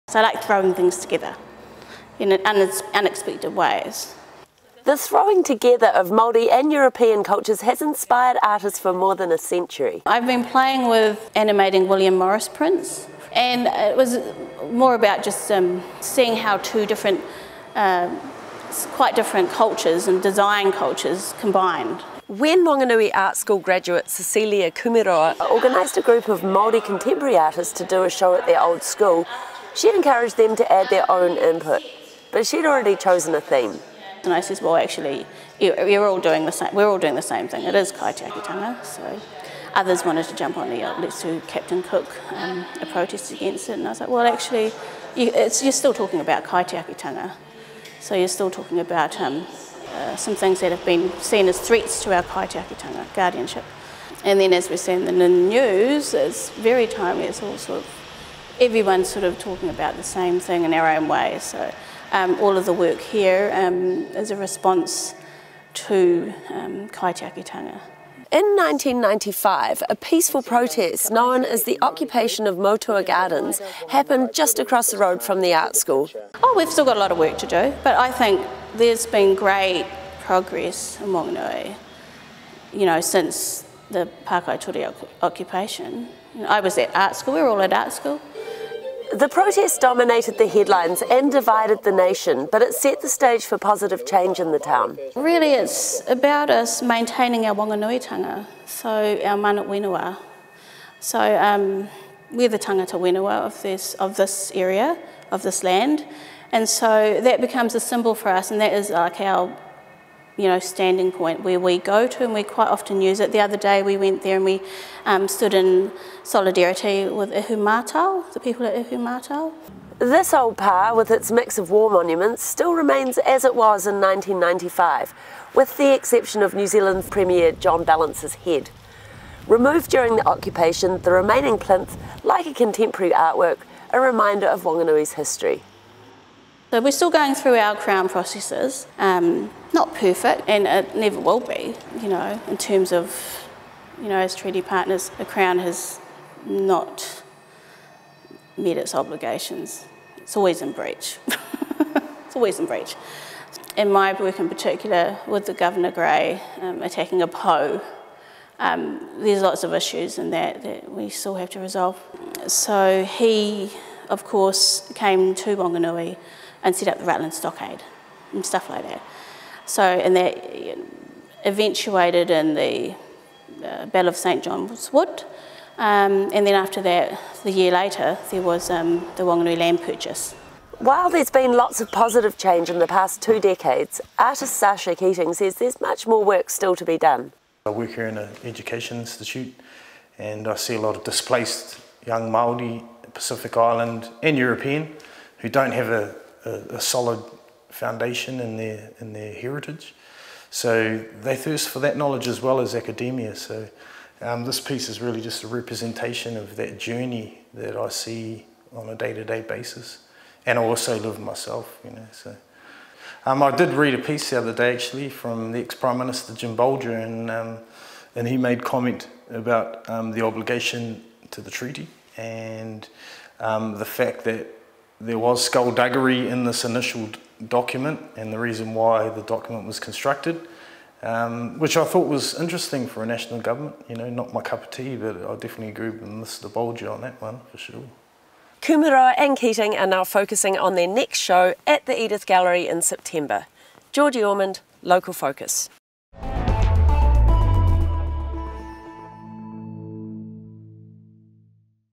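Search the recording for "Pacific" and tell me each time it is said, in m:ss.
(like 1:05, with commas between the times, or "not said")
3:13.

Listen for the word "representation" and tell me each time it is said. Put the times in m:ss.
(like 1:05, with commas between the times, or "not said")
3:25.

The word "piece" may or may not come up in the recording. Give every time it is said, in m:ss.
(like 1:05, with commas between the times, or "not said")
3:24, 3:34.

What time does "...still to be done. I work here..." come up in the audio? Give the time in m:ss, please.
3:06.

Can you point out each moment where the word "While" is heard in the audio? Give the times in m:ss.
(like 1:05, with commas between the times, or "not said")
3:00.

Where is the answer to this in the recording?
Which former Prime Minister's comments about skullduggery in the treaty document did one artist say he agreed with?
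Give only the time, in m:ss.
3:36.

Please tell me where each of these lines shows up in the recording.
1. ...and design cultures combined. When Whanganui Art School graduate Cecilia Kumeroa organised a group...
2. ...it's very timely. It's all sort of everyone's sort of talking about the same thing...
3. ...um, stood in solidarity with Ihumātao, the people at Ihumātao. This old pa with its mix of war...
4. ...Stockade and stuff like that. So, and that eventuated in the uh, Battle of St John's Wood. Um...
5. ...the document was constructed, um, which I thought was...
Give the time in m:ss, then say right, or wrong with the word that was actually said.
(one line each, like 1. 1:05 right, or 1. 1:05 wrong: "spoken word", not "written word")
1. 0:20 right
2. 0:56 right
3. 1:55 right
4. 2:47 right
5. 3:49 right.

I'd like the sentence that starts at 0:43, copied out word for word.
And I was like, well, actually, you, are still talking about kaitiakitanga.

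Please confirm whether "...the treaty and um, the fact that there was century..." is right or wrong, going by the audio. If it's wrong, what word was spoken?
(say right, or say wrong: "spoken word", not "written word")
wrong: "skullduggery", not "century".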